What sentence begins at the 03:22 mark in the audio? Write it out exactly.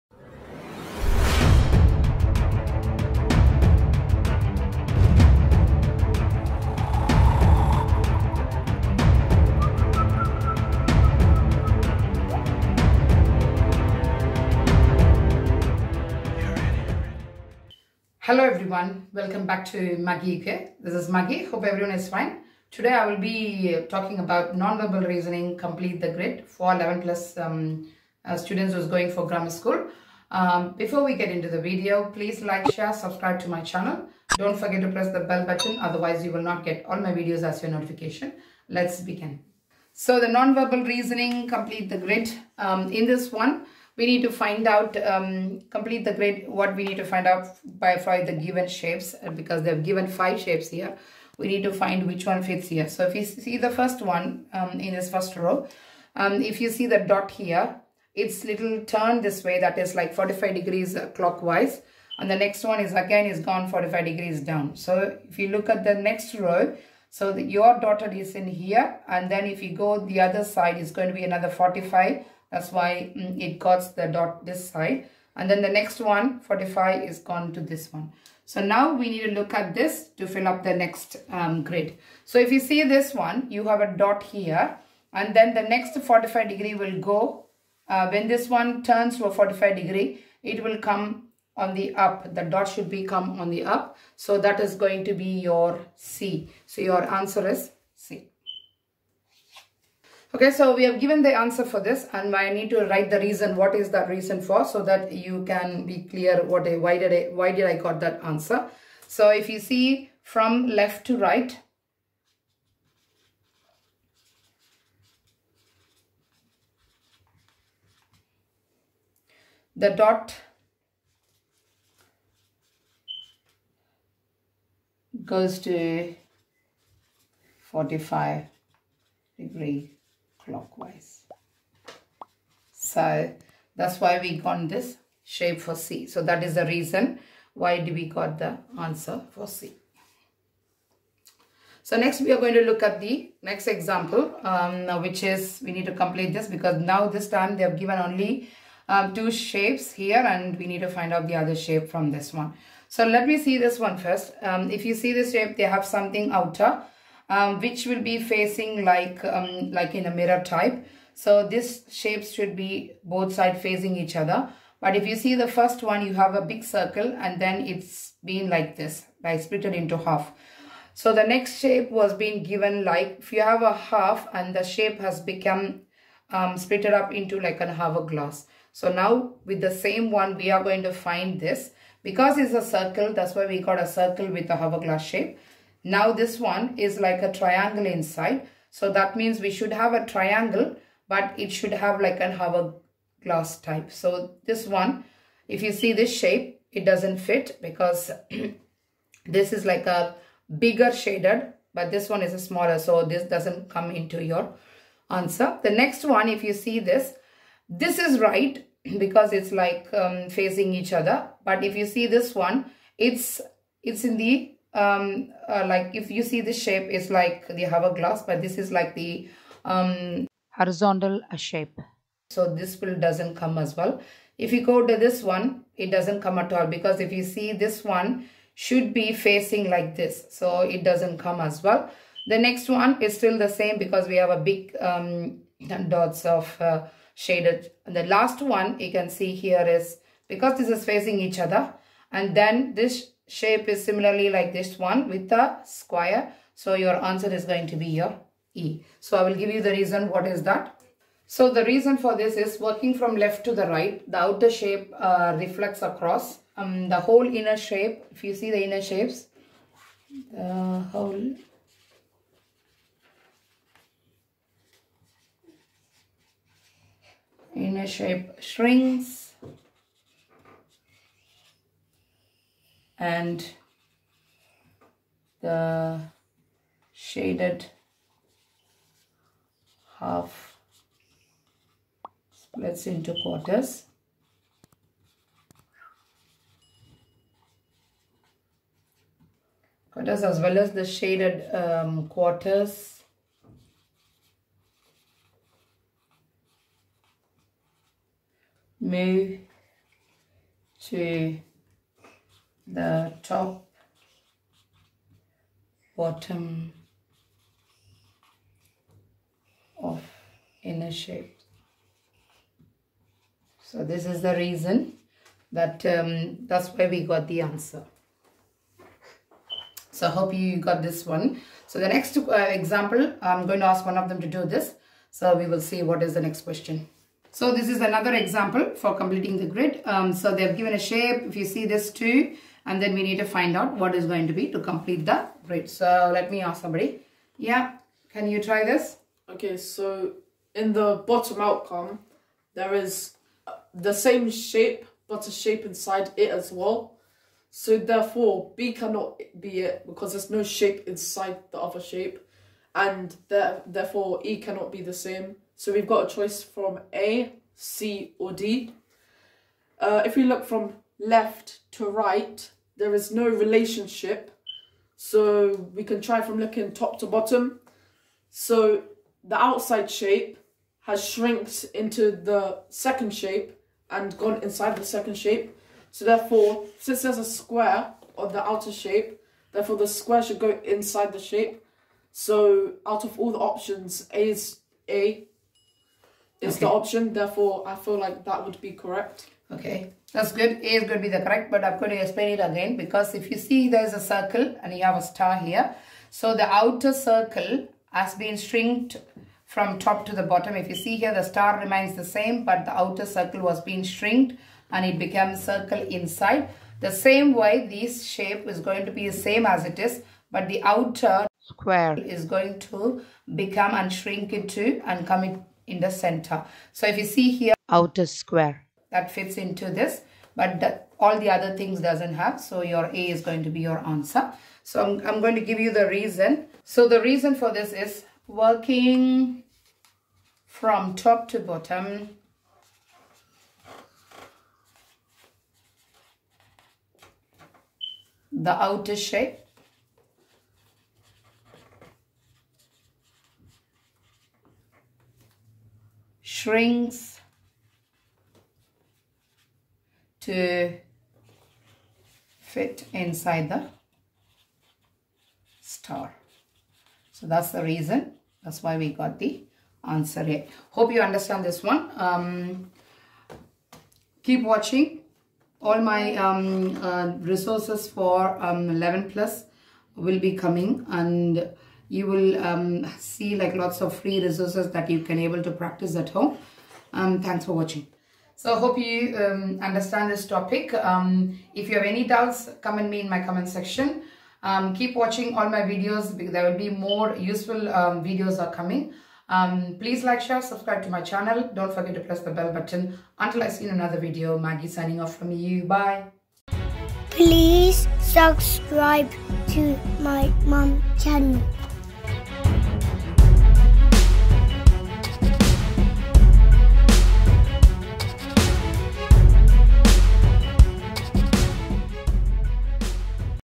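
So this doesn't come into your answer.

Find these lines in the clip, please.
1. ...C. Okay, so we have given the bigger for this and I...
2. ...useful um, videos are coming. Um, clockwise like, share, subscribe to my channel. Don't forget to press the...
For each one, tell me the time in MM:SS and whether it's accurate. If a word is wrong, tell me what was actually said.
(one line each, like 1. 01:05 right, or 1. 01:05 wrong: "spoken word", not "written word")
1. 01:37 wrong: "answer", not "bigger"
2. 08:07 wrong: "please", not "clockwise".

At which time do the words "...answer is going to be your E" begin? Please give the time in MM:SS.
04:07.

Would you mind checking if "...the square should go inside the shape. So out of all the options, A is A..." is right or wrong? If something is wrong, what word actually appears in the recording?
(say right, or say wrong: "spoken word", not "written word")
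right.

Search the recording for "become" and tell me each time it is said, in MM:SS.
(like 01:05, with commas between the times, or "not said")
02:55, 06:53.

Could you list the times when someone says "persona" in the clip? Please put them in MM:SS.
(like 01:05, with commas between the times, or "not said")
not said.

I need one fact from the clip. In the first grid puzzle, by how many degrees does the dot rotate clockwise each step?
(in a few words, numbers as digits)
45.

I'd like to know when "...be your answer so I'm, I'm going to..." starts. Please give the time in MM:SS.
07:03.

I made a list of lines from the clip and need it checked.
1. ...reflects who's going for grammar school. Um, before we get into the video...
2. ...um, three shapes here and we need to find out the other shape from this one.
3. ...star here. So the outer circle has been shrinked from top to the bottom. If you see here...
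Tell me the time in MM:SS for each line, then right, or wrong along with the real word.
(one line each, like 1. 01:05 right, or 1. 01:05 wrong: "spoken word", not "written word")
1. 00:28 wrong: "students", not "reflects"
2. 02:28 wrong: "two", not "three"
3. 06:35 right.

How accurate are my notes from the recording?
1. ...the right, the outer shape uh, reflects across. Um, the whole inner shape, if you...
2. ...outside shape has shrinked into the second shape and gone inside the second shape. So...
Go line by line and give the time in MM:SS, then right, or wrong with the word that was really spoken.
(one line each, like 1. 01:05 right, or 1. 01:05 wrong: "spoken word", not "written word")
1. 04:13 right
2. 06:09 right.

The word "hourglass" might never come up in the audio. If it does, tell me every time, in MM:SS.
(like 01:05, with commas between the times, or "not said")
02:57, 03:04, 03:12, 03:37.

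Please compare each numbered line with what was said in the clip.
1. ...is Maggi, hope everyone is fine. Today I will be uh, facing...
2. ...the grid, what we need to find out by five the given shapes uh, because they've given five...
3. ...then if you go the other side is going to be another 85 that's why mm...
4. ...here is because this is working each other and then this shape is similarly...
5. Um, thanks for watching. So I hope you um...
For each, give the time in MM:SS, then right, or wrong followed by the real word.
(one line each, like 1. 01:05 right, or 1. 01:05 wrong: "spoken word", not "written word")
1. 00:20 wrong: "talking", not "facing"
2. 00:46 right
3. 01:09 wrong: "45", not "85"
4. 03:59 wrong: "facing", not "working"
5. 07:56 right.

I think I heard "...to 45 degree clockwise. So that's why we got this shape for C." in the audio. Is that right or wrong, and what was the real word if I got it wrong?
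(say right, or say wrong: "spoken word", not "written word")
right.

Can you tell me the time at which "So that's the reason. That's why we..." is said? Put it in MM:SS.
07:37.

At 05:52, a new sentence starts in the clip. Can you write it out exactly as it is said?
And there, therefore, E cannot be the same.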